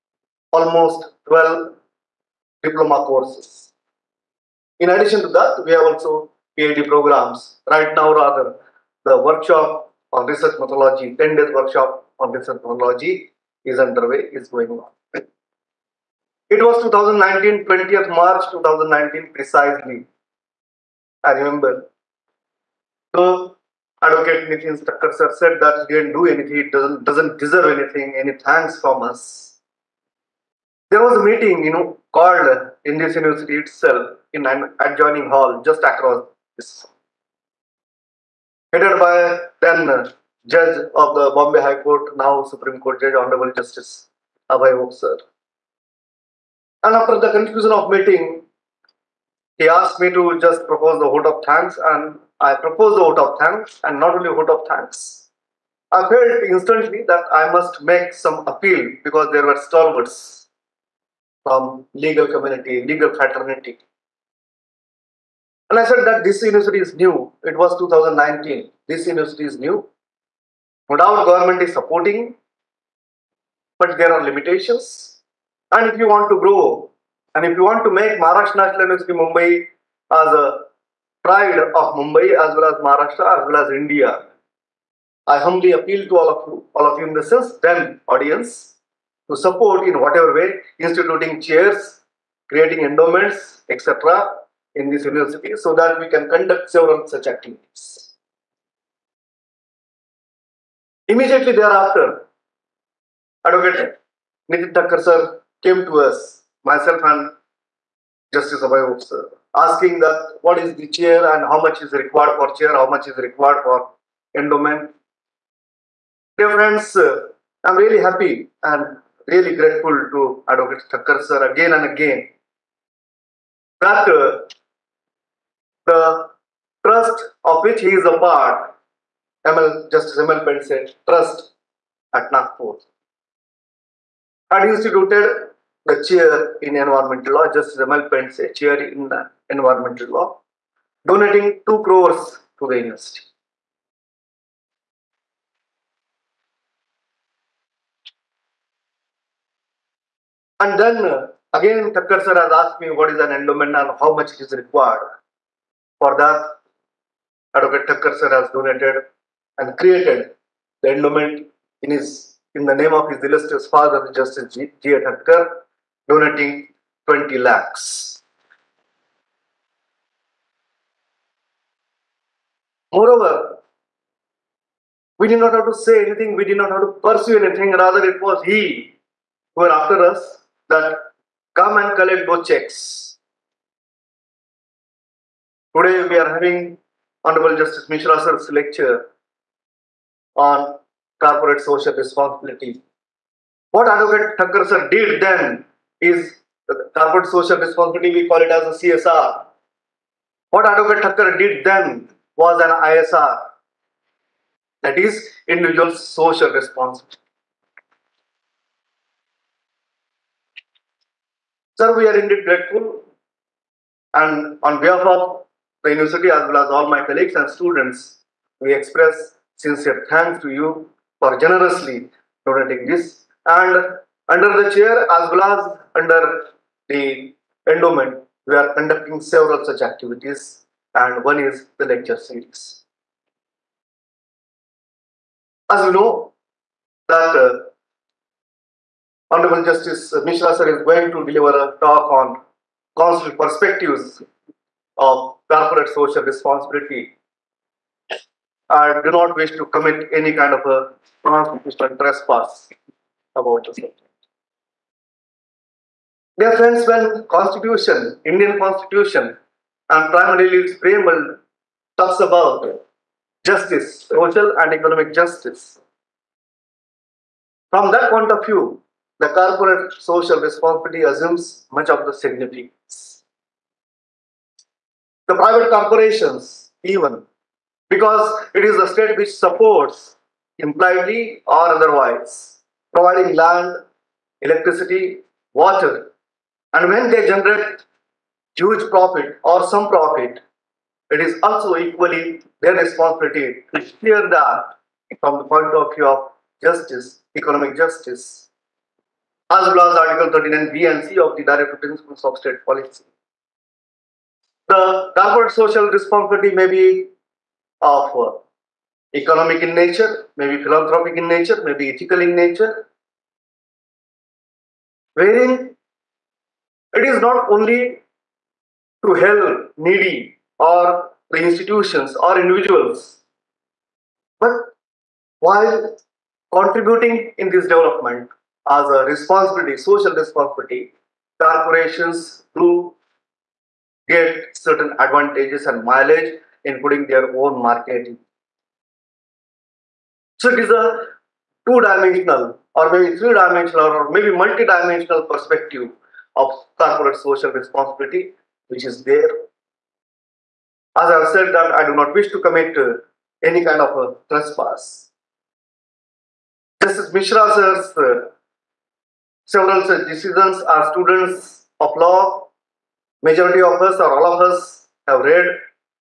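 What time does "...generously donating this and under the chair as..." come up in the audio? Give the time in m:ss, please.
3:41.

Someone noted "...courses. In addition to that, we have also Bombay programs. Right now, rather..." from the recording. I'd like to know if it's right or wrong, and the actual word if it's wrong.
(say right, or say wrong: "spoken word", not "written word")
wrong: "PhD", not "Bombay".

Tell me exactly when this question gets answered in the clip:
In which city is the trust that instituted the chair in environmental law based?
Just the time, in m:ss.
2:12.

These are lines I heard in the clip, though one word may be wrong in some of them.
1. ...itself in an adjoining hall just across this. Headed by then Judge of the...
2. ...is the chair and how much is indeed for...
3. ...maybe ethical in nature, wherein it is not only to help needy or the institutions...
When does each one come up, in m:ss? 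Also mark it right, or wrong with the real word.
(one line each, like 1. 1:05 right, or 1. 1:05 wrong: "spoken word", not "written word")
1. 0:33 right
2. 1:50 wrong: "required", not "indeed"
3. 5:11 right.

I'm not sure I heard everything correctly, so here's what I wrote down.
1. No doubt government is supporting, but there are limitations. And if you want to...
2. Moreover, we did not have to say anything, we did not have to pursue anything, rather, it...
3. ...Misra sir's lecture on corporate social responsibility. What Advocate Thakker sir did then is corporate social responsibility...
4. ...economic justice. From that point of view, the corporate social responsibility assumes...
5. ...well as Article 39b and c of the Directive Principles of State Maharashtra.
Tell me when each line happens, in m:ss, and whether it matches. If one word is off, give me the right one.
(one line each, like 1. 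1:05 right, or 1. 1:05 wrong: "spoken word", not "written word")
1. 1:10 right
2. 2:52 right
3. 3:07 right
4. 4:24 right
5. 4:59 wrong: "Policy", not "Maharashtra".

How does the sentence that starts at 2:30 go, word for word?
And then uh, again Thakker sir has asked me what is an endowment and how much it is required.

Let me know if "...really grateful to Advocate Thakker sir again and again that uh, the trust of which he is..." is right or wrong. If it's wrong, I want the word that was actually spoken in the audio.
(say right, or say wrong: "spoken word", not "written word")
right.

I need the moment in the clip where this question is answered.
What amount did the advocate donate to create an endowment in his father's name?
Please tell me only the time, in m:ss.
2:47.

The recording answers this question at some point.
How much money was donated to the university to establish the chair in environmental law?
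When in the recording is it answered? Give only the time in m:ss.
2:21.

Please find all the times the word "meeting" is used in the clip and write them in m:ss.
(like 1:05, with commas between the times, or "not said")
0:31, 0:47.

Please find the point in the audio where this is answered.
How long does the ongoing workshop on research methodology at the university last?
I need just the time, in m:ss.
0:11.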